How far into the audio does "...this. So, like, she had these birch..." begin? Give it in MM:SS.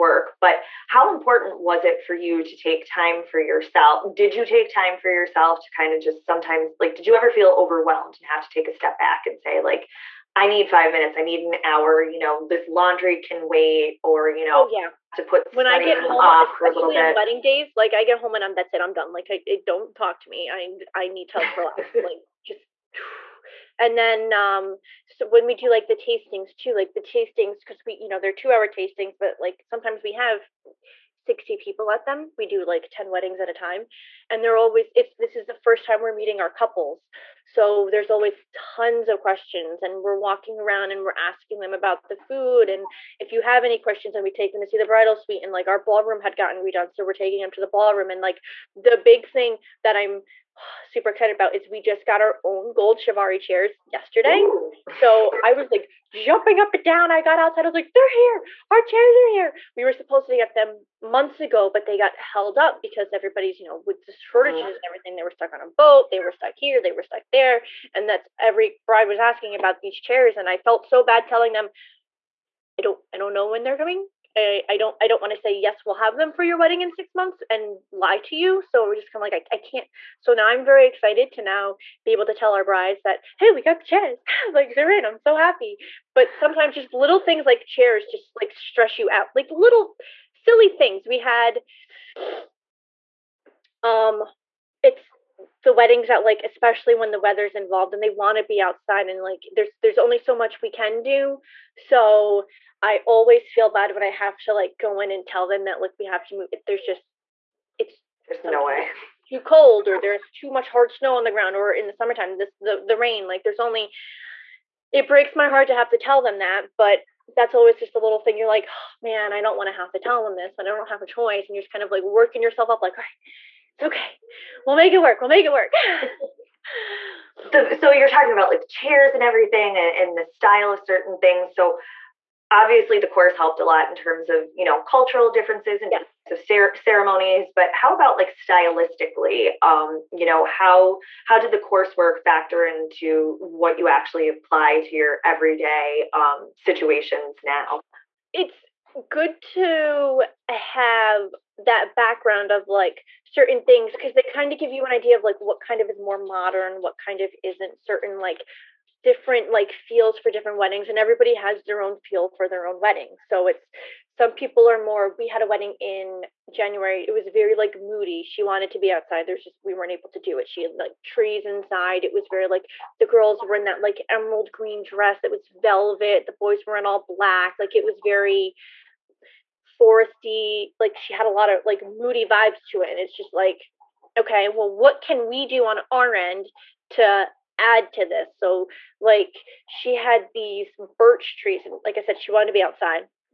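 03:08.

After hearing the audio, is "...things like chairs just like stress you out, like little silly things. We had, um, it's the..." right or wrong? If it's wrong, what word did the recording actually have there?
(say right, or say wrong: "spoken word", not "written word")
right.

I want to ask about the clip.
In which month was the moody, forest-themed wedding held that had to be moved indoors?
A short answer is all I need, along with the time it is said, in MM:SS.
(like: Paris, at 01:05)
January, at 02:46.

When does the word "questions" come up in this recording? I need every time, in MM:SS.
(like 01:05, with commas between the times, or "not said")
00:39, 00:43.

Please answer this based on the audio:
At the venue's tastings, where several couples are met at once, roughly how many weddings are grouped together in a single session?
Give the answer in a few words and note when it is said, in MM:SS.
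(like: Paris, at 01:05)
10, at 00:32.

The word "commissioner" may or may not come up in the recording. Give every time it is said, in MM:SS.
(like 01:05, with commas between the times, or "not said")
not said.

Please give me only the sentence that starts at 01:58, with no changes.
You're like, oh, man, I don't want to have to tell them this, but I don't have a choice.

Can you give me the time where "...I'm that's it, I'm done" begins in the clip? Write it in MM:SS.
00:18.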